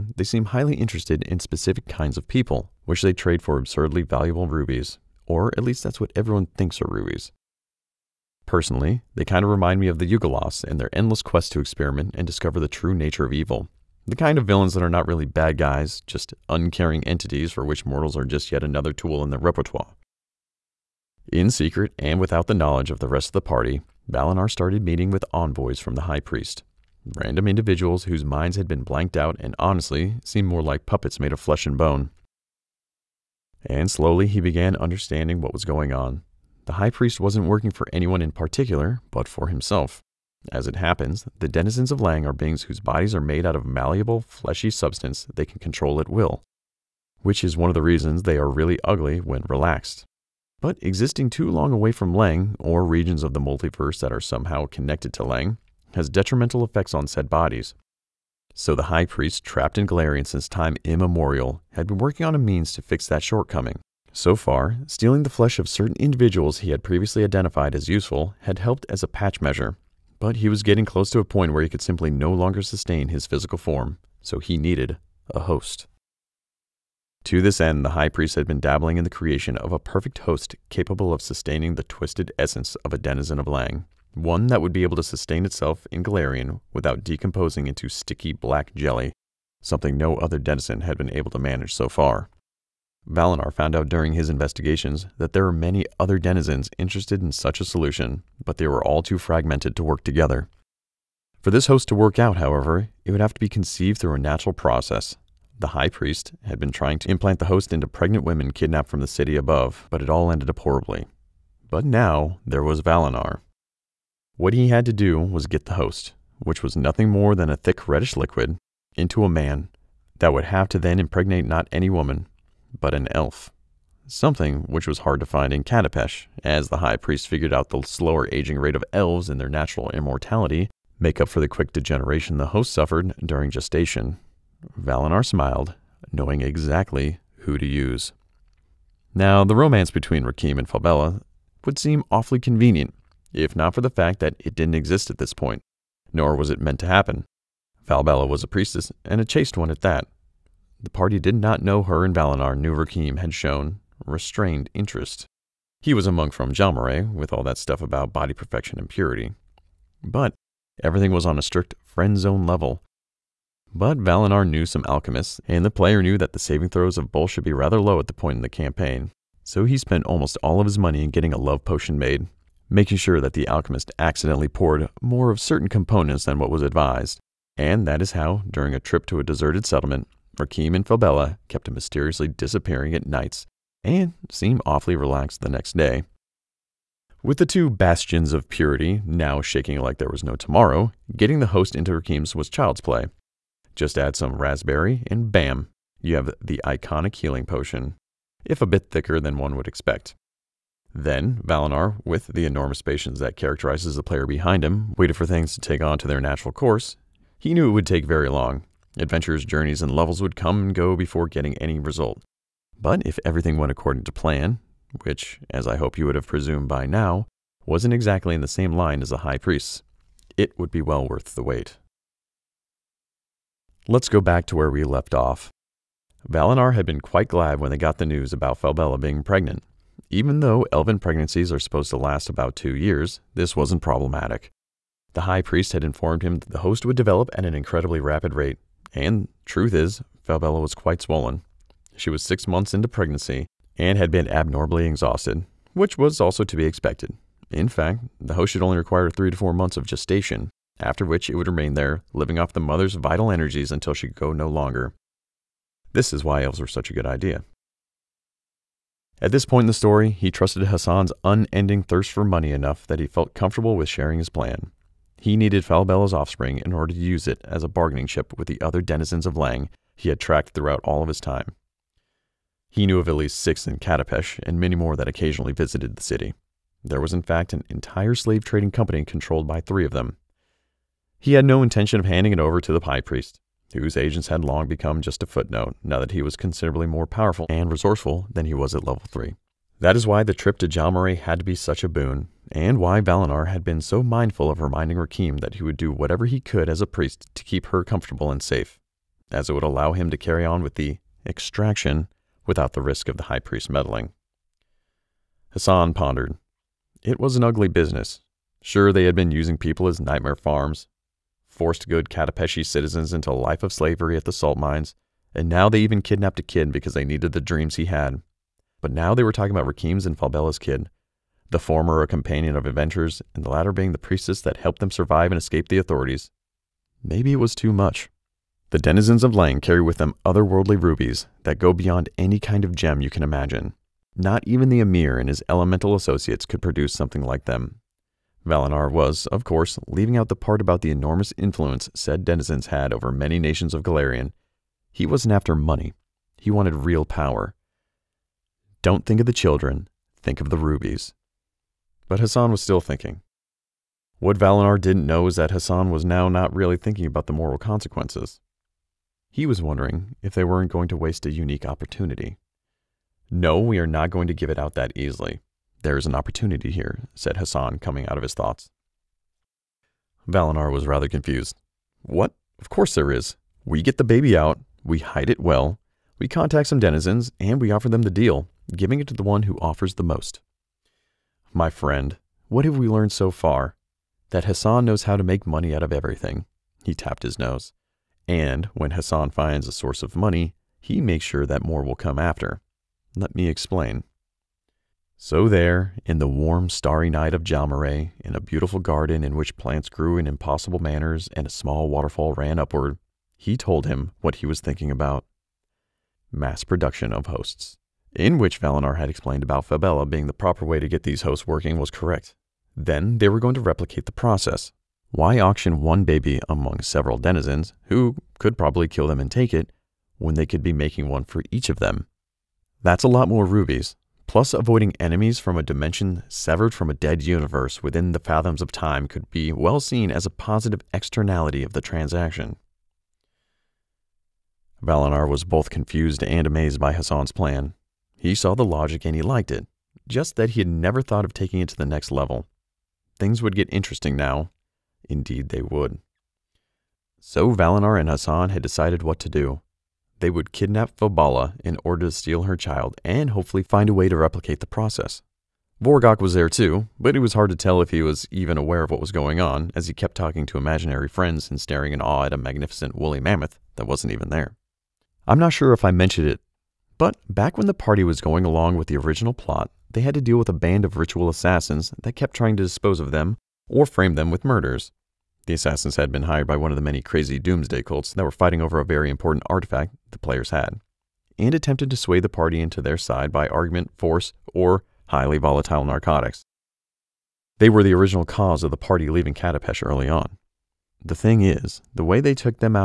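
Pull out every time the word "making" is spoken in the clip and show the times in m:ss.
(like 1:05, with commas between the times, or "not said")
2:52, 7:00.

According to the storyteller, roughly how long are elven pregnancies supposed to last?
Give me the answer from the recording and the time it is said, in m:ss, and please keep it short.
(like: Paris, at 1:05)
2 years, at 3:52.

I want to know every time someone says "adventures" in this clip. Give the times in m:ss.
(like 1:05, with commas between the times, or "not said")
3:28, 5:22.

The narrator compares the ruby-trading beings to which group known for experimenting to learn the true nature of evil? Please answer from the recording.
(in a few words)
Ugolos.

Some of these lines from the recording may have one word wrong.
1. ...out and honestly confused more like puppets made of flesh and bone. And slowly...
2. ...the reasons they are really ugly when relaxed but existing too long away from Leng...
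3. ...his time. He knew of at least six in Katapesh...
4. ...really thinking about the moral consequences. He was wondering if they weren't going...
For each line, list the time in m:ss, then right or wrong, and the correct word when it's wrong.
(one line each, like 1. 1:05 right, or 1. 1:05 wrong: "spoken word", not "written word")
1. 0:29 wrong: "seemed", not "confused"
2. 0:47 right
3. 4:31 right
4. 5:56 right.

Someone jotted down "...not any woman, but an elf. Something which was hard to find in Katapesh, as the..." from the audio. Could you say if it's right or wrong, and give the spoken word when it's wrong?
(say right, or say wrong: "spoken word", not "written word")
right.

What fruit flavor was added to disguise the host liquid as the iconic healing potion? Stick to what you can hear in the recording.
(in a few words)
raspberry.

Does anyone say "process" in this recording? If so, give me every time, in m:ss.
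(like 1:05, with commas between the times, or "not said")
1:44, 6:54, 7:34.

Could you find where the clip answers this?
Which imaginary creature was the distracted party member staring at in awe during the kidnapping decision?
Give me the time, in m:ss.
7:42.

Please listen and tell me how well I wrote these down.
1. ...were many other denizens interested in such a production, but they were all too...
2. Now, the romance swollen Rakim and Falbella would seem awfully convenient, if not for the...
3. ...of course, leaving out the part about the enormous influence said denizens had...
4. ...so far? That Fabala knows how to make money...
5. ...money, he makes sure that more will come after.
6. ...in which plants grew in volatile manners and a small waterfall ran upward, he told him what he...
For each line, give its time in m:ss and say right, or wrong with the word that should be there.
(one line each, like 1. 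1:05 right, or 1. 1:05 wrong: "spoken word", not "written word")
1. 1:35 wrong: "solution", not "production"
2. 2:19 wrong: "between", not "swollen"
3. 5:39 right
4. 6:23 wrong: "Hassan", not "Fabala"
5. 6:30 right
6. 6:39 wrong: "impossible", not "volatile".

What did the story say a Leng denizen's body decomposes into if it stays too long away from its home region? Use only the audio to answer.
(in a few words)
sticky black jelly.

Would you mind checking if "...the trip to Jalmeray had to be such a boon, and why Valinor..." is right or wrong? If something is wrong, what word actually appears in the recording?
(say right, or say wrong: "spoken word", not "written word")
right.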